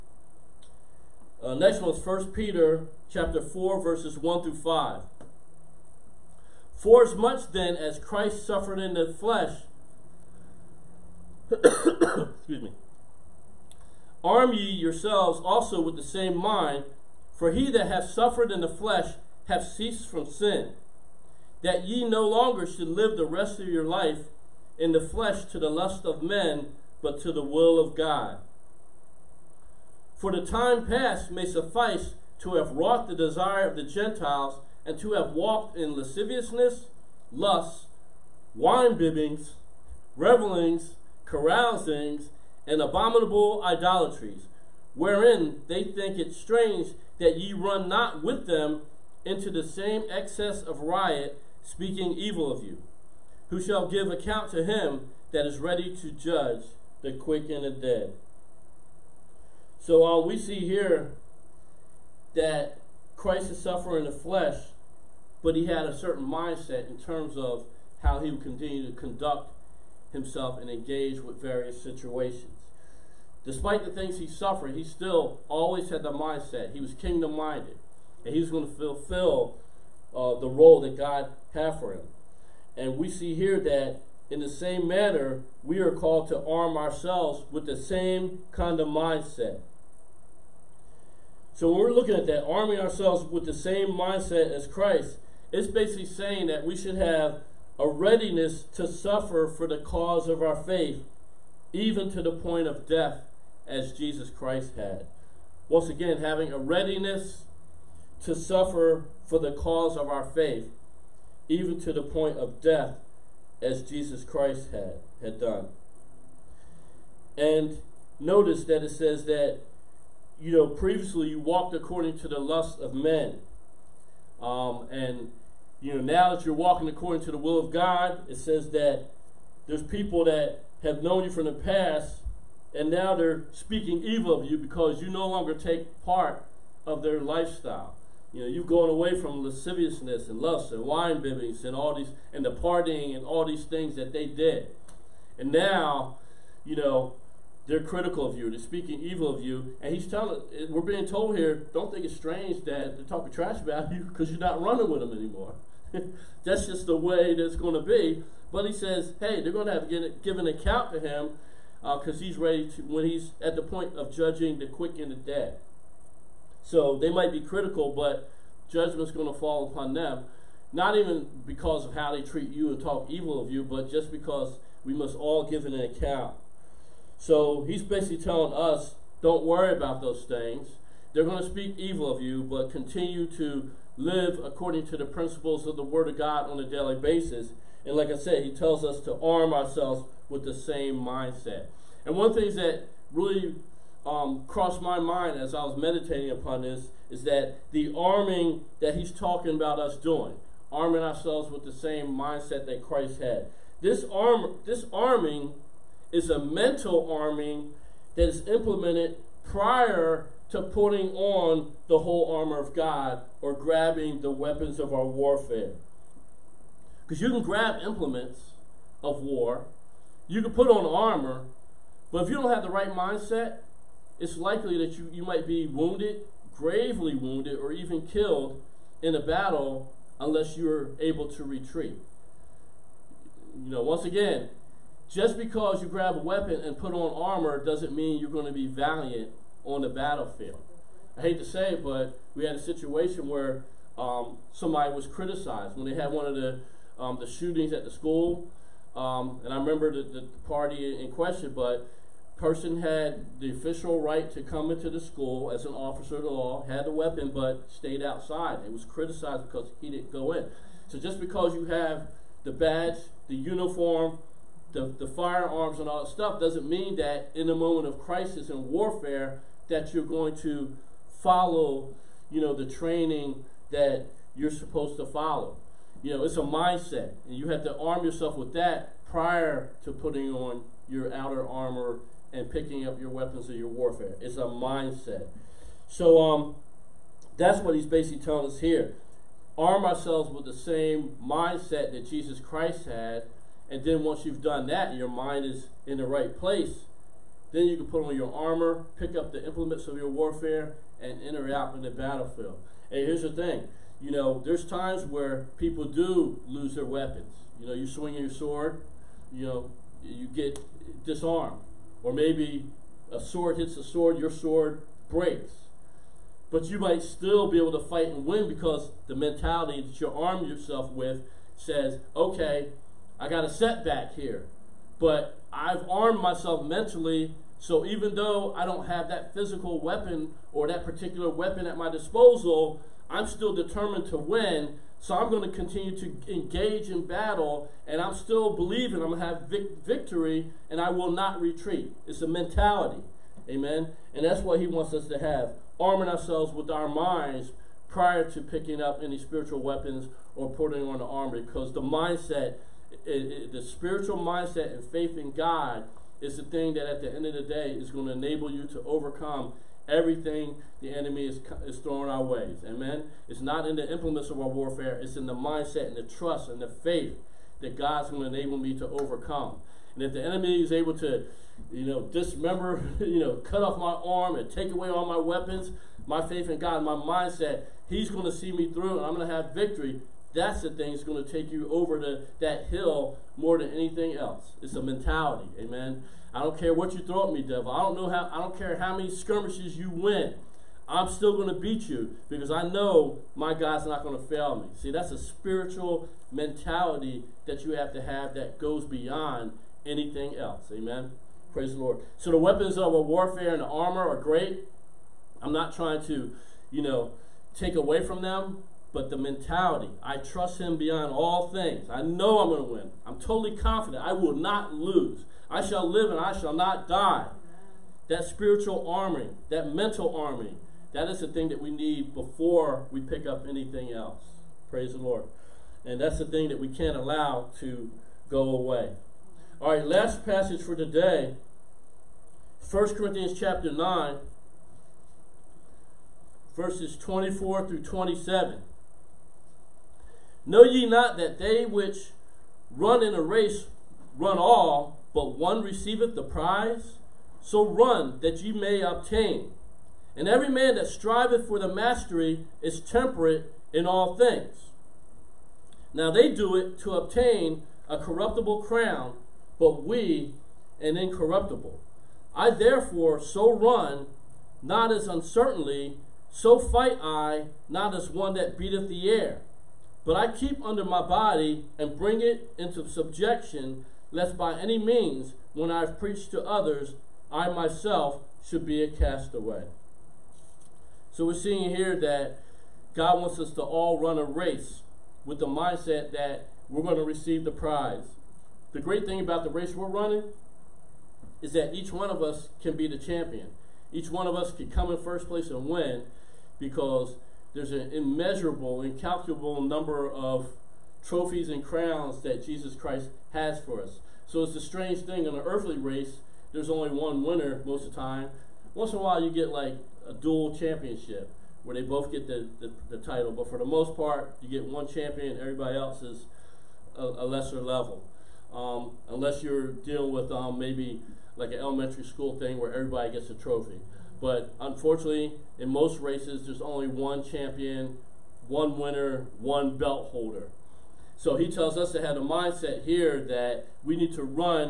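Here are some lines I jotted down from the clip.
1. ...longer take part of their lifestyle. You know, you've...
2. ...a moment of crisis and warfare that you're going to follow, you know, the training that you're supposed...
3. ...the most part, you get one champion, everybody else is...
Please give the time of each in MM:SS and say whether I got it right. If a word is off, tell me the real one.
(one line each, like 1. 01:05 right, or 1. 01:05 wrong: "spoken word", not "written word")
1. 02:15 right
2. 04:27 right
3. 08:33 right.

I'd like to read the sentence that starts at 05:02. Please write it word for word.
And here's the thing you know, there's times where people do lose their weapons.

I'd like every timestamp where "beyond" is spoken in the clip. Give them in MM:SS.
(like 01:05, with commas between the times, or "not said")
06:38, 06:50.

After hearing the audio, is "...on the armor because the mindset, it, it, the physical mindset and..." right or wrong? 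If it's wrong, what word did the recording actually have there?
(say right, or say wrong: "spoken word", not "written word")
wrong: "spiritual", not "physical".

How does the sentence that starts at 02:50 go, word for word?
Not even because of how they treat you and talk evil of you, but just because we must all give an account.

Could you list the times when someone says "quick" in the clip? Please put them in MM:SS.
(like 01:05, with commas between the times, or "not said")
00:57, 02:44.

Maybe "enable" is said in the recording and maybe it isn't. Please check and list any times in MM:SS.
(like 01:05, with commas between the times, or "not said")
05:58, 06:08.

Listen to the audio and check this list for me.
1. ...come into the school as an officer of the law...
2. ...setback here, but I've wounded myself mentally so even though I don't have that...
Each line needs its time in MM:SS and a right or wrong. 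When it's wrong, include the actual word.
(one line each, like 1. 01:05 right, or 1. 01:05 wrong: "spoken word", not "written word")
1. 04:14 right
2. 05:23 wrong: "armed", not "wounded".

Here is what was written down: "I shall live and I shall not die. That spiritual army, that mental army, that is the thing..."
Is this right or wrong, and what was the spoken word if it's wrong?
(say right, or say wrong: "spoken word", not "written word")
right.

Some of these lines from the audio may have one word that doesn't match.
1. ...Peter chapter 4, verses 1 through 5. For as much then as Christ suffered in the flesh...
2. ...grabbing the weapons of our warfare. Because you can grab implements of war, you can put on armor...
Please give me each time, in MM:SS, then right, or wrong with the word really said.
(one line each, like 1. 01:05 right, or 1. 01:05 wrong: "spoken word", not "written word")
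1. 00:02 right
2. 03:33 right.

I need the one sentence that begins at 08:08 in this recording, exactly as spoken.
The great thing about the race we're running is that each one of us can be the champion.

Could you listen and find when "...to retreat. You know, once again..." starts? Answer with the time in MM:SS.
03:51.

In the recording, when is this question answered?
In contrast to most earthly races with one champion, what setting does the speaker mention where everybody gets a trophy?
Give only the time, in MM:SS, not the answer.
08:41.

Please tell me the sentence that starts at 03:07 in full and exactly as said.
And like I said, he tells us to arm ourselves with the same mindset.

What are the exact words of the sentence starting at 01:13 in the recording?
Despite the things he suffered, he still always had the mindset.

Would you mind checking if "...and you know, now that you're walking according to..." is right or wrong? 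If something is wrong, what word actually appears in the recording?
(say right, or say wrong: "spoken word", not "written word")
right.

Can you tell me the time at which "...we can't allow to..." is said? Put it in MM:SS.
07:06.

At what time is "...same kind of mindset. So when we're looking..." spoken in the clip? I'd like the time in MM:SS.
01:27.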